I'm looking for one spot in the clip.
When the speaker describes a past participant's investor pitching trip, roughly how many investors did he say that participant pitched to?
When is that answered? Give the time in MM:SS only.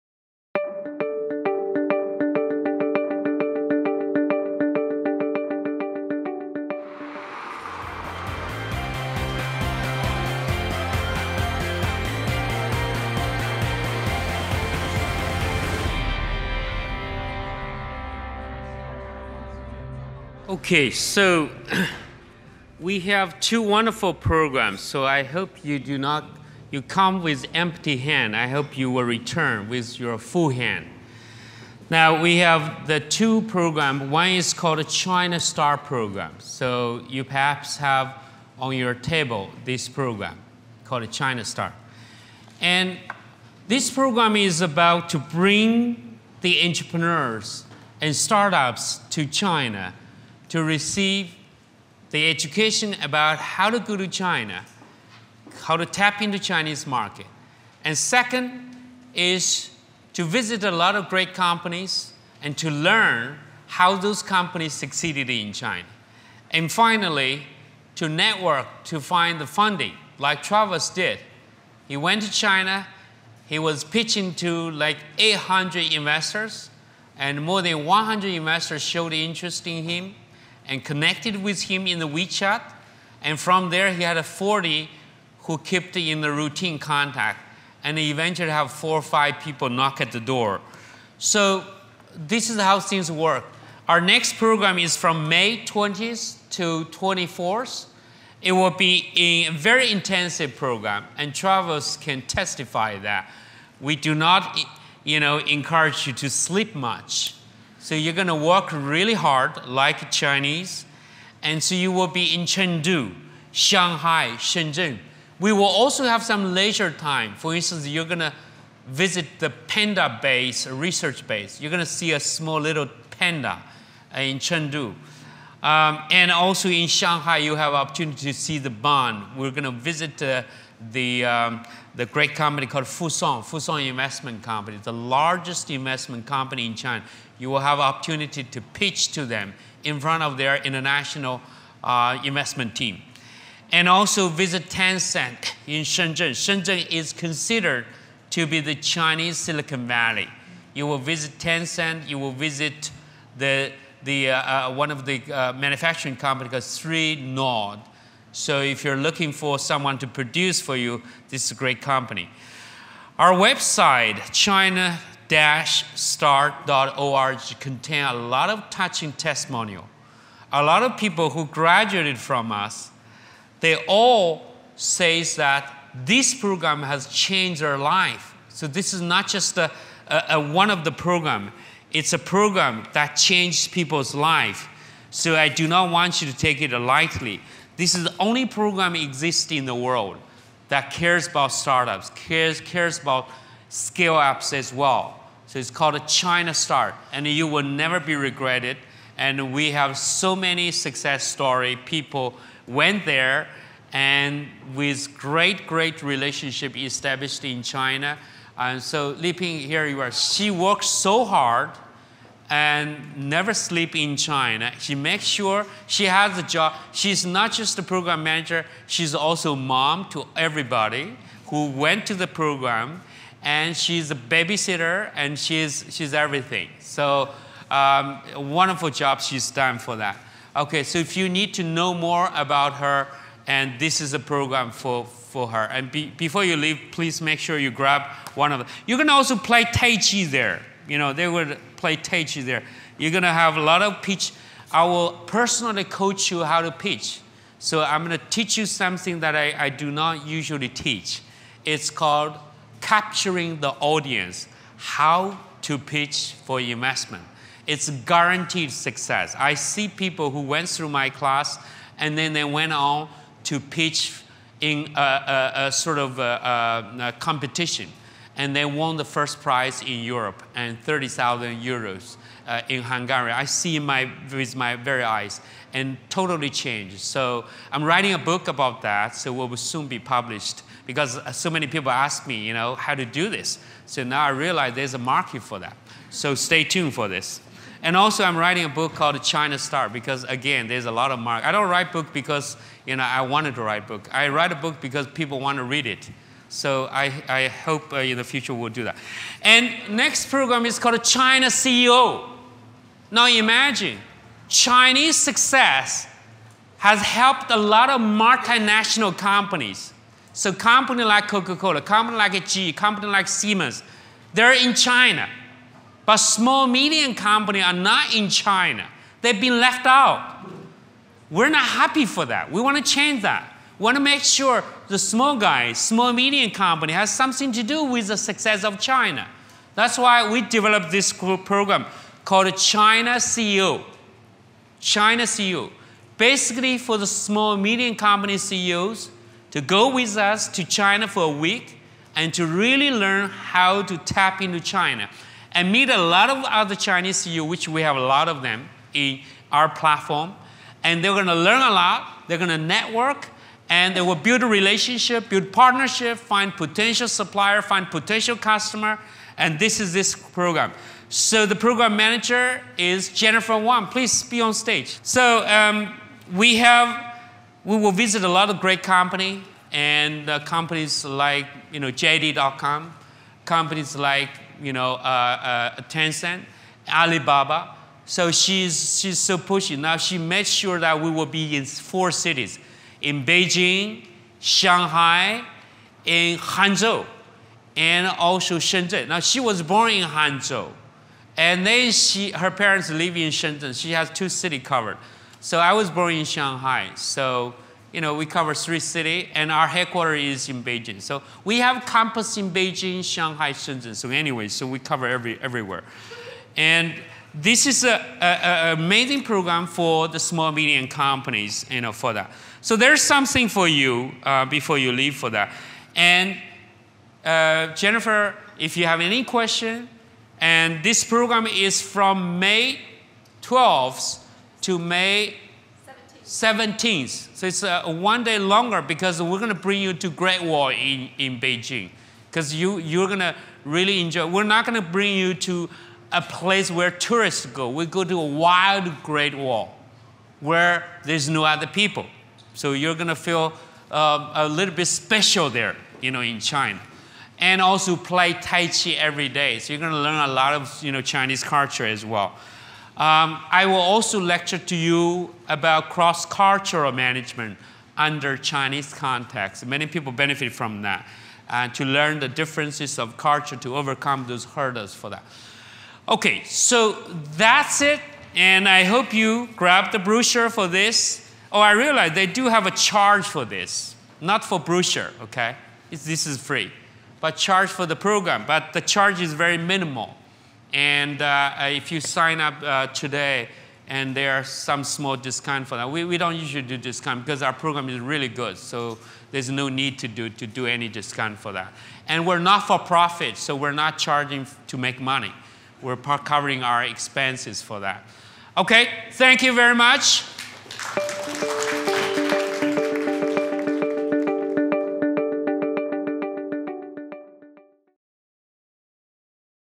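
01:15.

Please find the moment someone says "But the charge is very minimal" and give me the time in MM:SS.
07:58.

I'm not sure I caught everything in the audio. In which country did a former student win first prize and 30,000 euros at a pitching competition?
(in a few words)
Hungary.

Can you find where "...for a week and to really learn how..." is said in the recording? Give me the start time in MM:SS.
05:41.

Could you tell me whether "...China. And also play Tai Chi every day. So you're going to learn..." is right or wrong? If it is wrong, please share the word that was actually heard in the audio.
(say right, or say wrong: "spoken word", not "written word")
right.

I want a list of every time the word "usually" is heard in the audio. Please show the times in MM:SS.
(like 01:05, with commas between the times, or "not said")
04:10, 08:06.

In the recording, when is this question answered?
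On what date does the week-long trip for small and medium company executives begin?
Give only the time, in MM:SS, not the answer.
07:02.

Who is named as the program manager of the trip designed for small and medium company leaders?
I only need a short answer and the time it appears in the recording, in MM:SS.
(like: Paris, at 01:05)
Jennifer Wang, at 06:03.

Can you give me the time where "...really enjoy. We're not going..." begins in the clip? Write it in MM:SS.
07:13.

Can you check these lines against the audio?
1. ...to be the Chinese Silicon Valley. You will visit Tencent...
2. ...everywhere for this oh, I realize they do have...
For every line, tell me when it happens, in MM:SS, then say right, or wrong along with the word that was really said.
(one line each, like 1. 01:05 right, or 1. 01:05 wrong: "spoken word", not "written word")
1. 02:28 right
2. 07:49 wrong: "brochure", not "everywhere".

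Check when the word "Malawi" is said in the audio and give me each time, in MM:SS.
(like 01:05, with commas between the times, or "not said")
not said.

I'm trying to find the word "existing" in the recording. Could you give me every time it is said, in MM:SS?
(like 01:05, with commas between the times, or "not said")
03:08.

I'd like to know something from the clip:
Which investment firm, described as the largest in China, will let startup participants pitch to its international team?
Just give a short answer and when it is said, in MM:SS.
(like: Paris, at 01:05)
Fosun, at 02:13.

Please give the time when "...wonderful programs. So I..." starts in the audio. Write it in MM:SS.
00:23.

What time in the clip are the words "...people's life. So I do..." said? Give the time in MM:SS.
03:03.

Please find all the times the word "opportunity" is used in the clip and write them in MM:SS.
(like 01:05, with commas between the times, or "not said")
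02:07, 02:17.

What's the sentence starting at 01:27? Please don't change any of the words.
And he eventually have four or five people knock at the door.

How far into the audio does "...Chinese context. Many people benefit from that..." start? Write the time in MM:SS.
07:38.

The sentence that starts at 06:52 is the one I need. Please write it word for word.
So there's something for you uh, before you leave for that.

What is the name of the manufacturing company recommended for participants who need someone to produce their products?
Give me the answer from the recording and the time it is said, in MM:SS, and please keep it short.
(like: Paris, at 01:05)
3 Nord, at 02:36.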